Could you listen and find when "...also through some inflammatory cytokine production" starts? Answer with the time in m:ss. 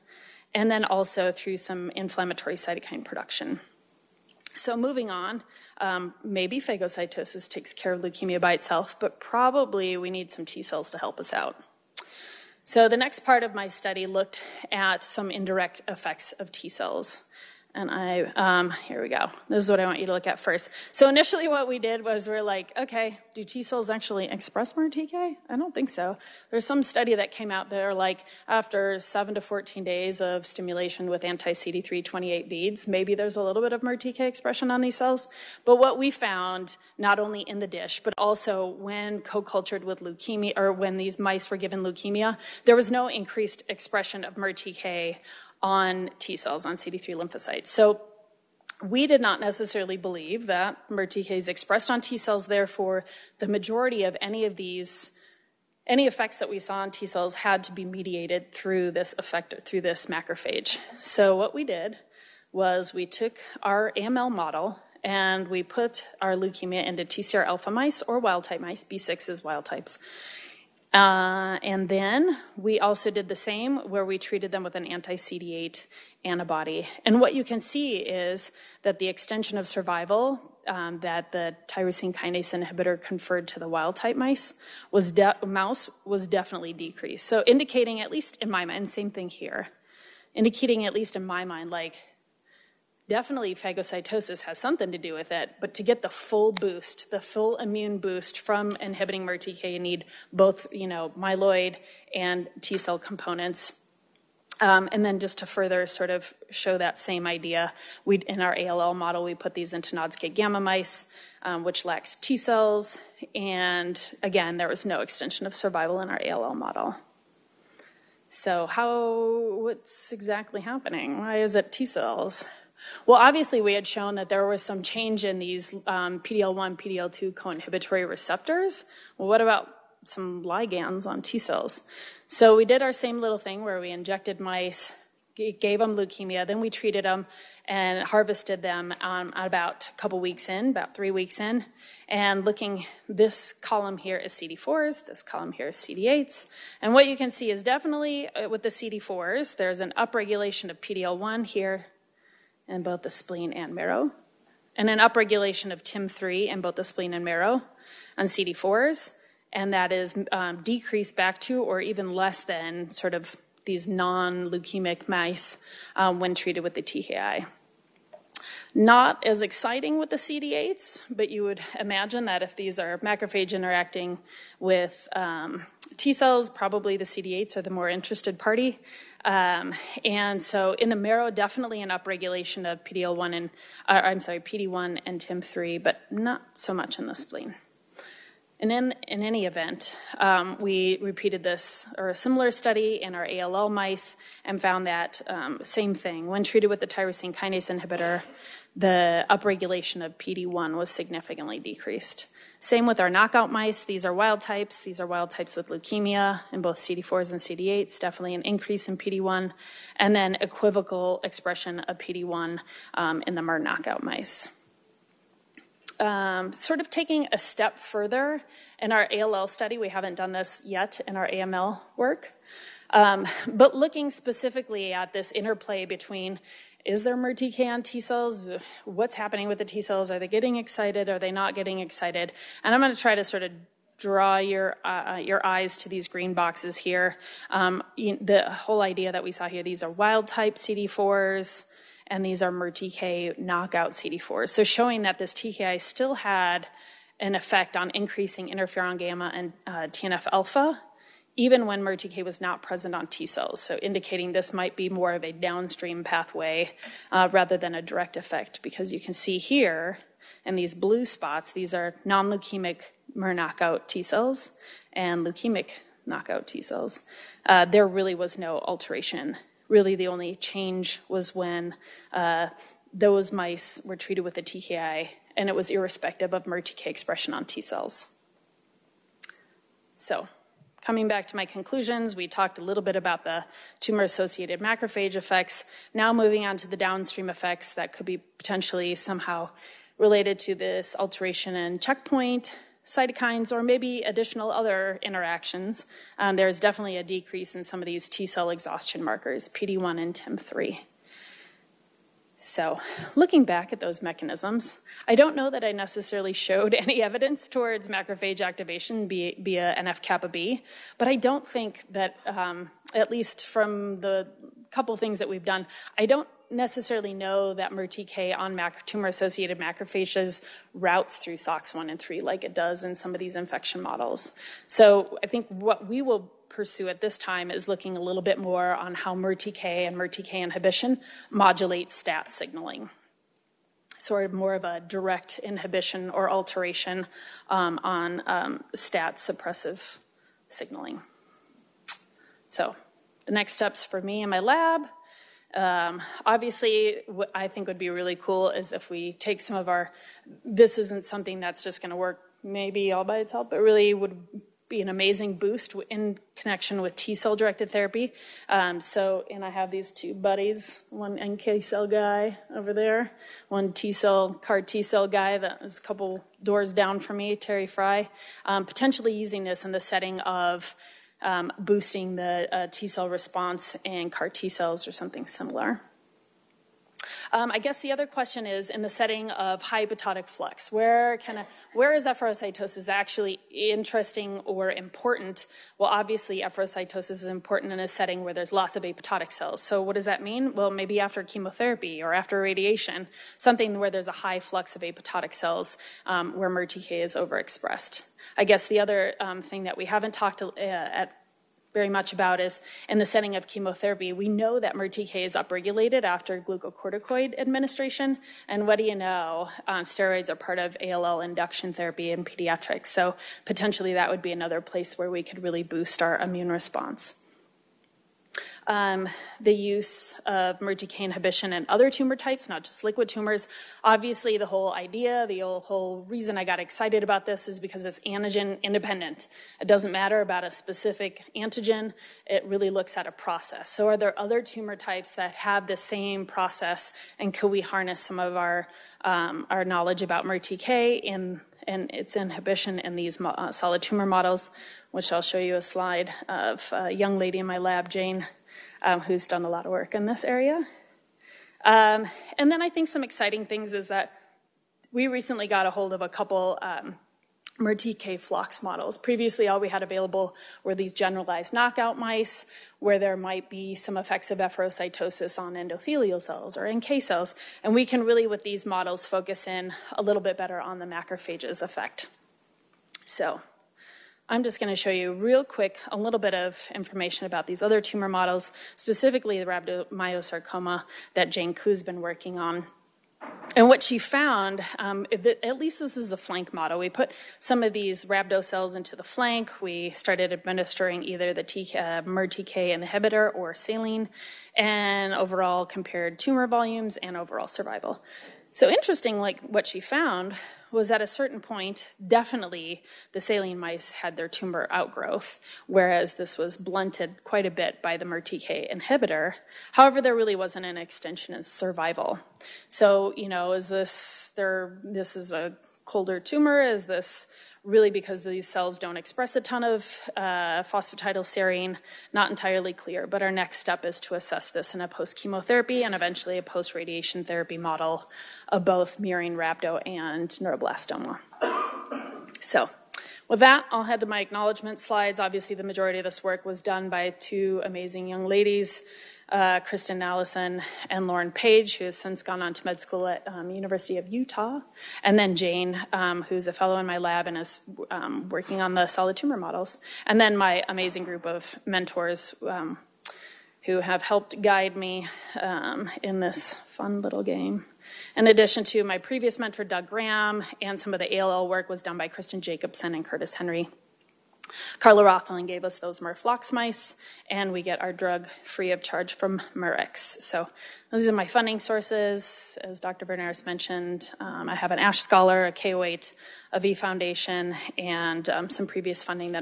0:00.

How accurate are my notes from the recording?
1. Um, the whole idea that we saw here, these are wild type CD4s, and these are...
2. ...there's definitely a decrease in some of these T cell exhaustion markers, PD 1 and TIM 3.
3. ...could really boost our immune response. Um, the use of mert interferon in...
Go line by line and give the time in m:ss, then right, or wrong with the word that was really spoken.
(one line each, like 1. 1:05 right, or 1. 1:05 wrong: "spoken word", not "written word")
1. 3:57 right
2. 4:56 right
3. 6:55 wrong: "inhibition", not "interferon".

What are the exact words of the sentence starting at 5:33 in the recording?
Sort of more of a direct inhibition or alteration um, on um, STAT suppressive signaling.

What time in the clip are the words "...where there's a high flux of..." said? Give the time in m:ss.
6:33.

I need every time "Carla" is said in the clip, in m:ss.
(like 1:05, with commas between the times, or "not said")
9:24.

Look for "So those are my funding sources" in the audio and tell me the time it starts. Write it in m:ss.
9:30.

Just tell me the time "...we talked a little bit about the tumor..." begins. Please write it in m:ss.
4:42.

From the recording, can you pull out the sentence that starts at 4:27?
Uh, there really was no alteration.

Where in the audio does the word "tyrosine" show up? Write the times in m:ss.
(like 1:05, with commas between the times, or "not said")
1:21, 3:16.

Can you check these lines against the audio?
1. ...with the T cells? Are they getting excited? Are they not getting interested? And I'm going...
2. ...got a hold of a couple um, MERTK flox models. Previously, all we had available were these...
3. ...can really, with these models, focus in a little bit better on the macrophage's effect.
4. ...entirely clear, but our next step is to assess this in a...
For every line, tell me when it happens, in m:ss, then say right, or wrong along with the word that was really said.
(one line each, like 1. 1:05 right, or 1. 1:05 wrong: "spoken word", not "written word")
1. 3:49 wrong: "excited", not "interested"
2. 7:35 right
3. 7:47 right
4. 8:42 right.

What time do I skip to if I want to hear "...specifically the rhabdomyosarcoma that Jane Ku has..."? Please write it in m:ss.
7:58.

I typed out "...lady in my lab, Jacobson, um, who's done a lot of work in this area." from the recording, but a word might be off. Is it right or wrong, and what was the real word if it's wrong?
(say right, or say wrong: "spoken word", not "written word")
wrong: "Jane", not "Jacobson".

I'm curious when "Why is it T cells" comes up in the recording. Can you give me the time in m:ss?
2:01.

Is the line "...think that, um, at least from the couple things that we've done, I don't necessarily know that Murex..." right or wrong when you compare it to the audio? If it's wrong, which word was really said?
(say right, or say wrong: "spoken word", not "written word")
wrong: "MERTK", not "Murex".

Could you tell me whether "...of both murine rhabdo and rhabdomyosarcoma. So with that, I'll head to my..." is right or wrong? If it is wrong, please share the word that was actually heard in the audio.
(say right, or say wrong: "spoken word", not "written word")
wrong: "neuroblastoma", not "rhabdomyosarcoma".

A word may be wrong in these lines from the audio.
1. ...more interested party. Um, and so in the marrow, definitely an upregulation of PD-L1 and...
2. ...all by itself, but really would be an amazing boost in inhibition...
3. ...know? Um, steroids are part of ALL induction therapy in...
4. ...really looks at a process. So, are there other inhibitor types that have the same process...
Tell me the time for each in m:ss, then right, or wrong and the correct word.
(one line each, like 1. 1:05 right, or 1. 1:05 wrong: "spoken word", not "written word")
1. 2:57 right
2. 5:52 wrong: "connection", not "inhibition"
3. 6:48 right
4. 7:12 wrong: "tumor", not "inhibitor".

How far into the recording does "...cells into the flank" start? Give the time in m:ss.
8:08.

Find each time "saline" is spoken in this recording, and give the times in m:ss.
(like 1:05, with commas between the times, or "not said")
8:13, 8:23.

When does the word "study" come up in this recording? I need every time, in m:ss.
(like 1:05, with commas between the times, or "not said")
0:13, 0:26, 3:12, 3:39.